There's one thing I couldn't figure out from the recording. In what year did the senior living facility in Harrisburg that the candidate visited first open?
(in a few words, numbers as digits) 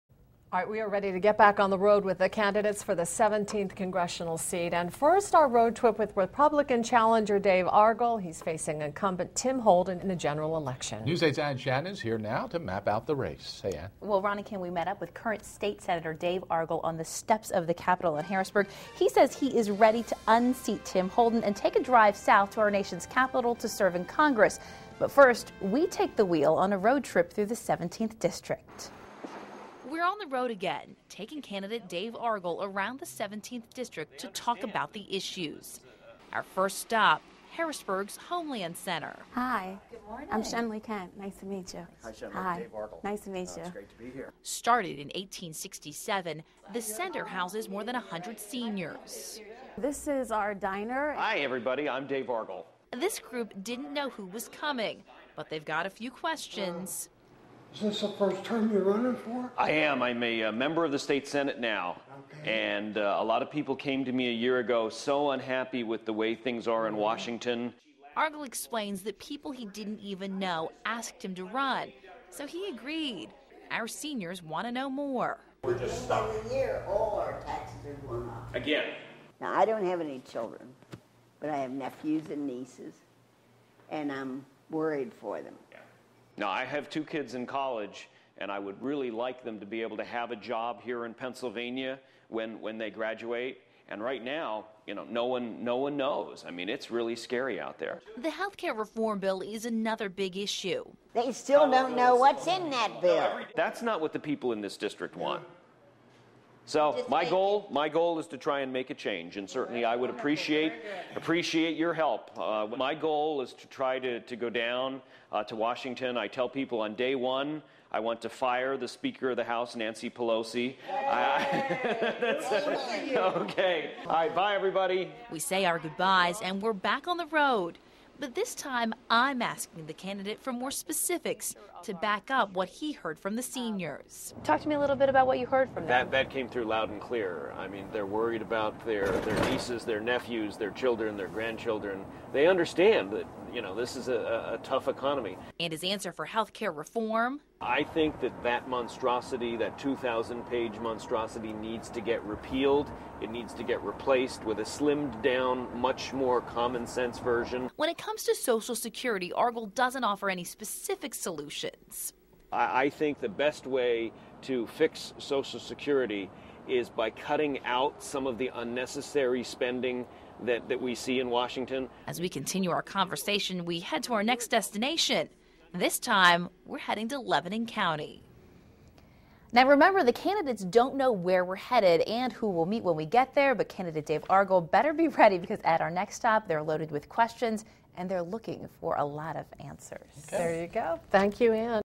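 1867.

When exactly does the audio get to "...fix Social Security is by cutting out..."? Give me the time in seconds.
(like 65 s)
164 s.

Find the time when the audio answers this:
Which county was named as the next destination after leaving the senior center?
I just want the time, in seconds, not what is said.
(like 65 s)
177 s.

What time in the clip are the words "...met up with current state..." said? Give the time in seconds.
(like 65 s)
14 s.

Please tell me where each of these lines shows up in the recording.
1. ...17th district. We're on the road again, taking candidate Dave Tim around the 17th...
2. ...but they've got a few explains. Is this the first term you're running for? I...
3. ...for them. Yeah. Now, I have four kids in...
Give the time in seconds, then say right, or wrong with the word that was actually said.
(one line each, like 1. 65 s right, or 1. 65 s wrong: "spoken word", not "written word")
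1. 27 s wrong: "Argall", not "Tim"
2. 55 s wrong: "questions", not "explains"
3. 85 s wrong: "two", not "four".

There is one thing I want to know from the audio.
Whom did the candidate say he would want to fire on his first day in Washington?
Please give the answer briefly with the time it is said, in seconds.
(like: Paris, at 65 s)
Nancy Pelosi, at 119 s.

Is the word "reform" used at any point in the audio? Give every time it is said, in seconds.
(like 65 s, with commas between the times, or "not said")
98 s, 146 s.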